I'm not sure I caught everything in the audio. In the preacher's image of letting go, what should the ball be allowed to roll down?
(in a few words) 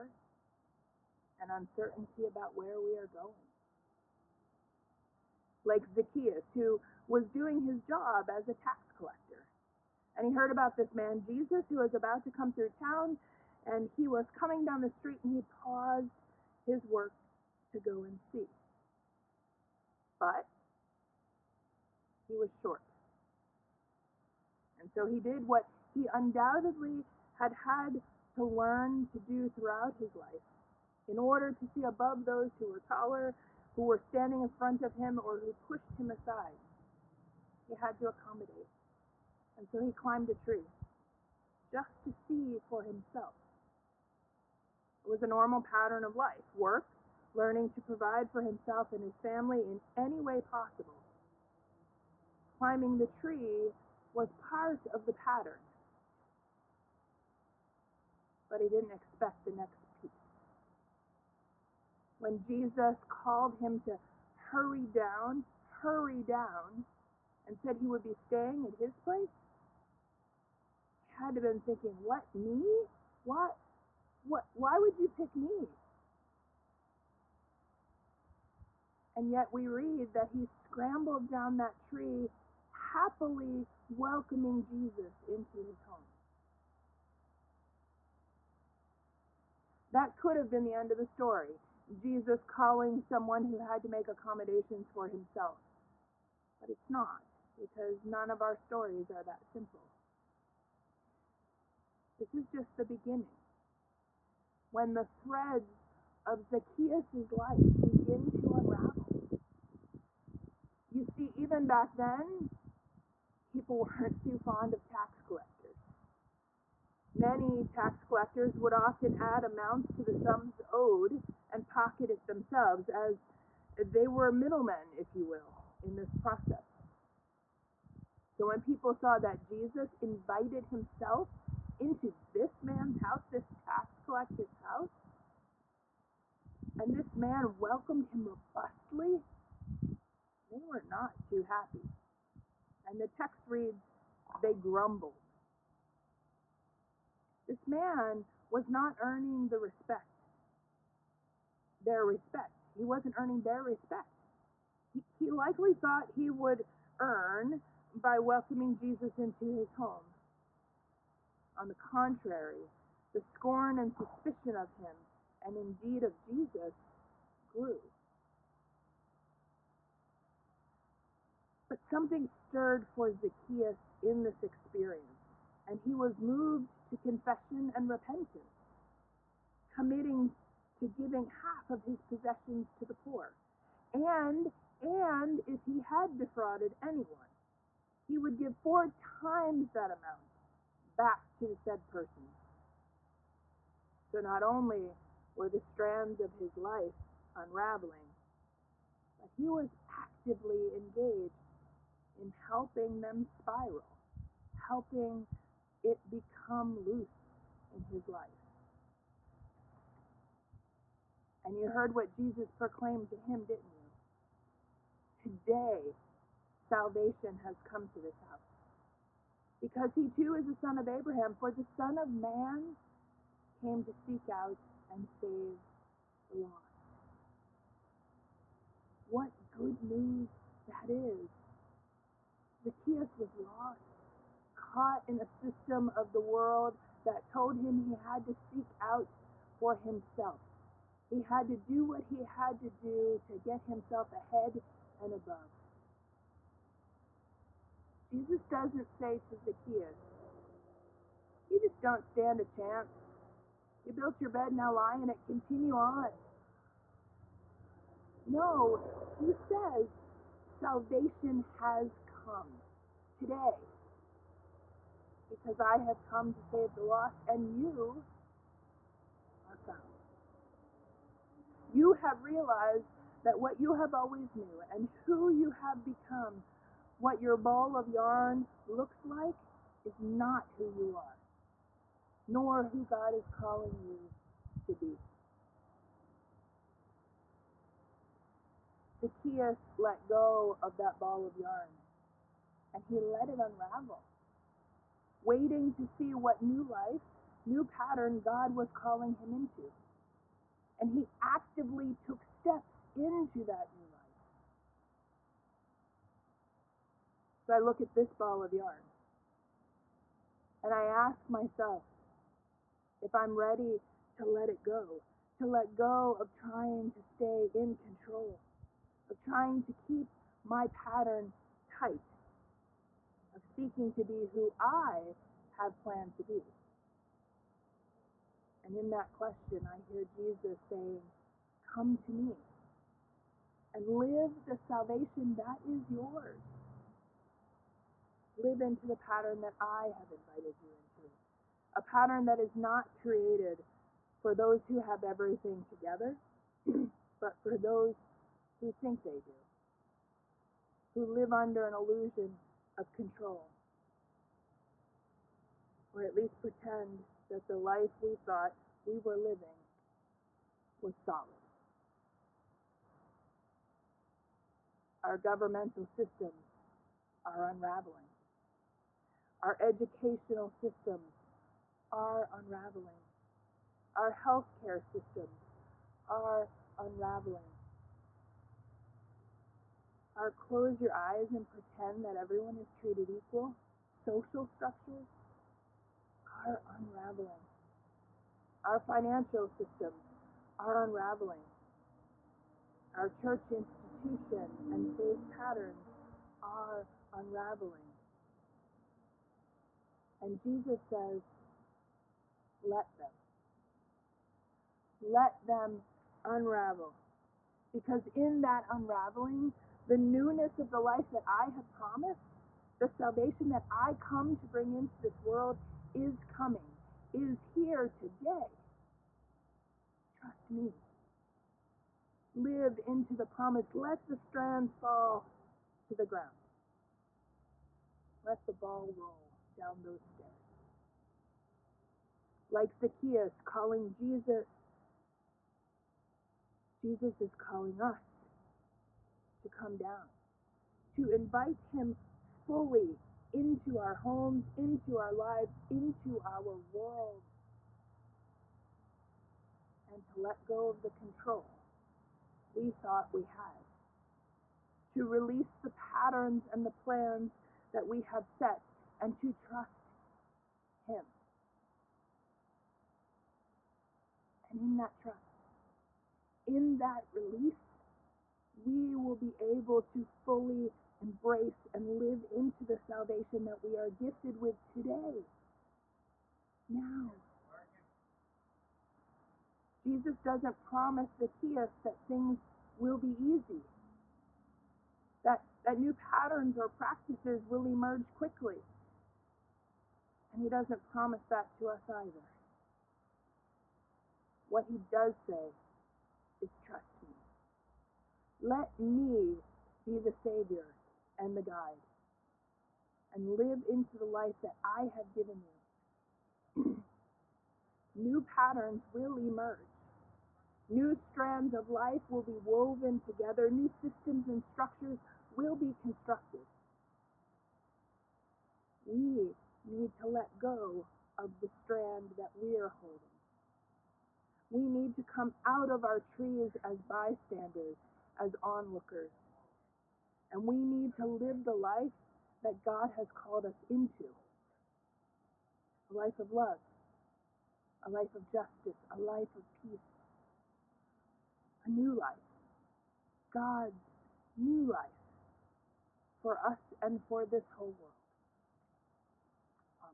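stairs.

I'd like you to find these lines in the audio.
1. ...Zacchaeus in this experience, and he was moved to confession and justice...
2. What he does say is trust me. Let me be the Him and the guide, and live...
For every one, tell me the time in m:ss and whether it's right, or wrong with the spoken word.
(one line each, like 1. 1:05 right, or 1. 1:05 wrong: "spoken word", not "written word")
1. 2:53 wrong: "repentance", not "justice"
2. 8:14 wrong: "Savior", not "Him".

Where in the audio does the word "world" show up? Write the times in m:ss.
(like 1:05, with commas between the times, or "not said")
3:56, 6:55, 7:26, 9:07.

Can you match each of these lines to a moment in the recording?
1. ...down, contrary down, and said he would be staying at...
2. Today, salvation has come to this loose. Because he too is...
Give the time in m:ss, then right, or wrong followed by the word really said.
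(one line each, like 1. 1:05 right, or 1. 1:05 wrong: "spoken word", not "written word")
1. 1:04 wrong: "hurry", not "contrary"
2. 3:35 wrong: "house", not "loose".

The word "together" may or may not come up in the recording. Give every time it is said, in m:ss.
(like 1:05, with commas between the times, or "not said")
5:45, 8:32.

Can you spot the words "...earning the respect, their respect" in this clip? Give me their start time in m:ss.
2:29.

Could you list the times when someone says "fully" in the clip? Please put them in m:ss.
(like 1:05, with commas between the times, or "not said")
7:22, 7:50.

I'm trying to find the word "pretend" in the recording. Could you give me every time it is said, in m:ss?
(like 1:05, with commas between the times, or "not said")
5:56, 6:21.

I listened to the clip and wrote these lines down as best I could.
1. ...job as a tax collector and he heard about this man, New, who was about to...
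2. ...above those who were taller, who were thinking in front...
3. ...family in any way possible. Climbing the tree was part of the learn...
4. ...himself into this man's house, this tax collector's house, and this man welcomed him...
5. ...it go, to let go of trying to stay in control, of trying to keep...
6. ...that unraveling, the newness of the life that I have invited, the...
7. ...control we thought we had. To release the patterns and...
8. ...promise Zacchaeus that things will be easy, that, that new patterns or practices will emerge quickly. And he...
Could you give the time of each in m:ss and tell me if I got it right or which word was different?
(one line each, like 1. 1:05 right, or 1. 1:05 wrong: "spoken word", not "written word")
1. 0:07 wrong: "Jesus", not "New"
2. 0:31 wrong: "standing", not "thinking"
3. 0:49 wrong: "pattern", not "learn"
4. 2:10 right
5. 5:14 right
6. 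6:48 wrong: "promised", not "invited"
7. 7:30 right
8. 8:00 right.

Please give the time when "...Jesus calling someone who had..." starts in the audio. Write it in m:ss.
1:31.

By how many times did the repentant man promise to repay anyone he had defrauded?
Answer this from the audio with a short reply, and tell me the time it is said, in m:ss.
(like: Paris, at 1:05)
4, at 3:08.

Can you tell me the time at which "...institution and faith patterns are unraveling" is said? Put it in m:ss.
6:33.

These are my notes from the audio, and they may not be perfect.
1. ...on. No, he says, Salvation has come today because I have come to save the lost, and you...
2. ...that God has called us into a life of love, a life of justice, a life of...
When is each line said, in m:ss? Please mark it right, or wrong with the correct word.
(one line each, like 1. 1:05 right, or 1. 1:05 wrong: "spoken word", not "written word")
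1. 4:15 right
2. 8:52 right.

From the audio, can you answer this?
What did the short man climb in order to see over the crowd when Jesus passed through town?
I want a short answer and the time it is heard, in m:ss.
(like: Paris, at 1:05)
a tree, at 0:40.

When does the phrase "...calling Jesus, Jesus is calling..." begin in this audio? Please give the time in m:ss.
7:13.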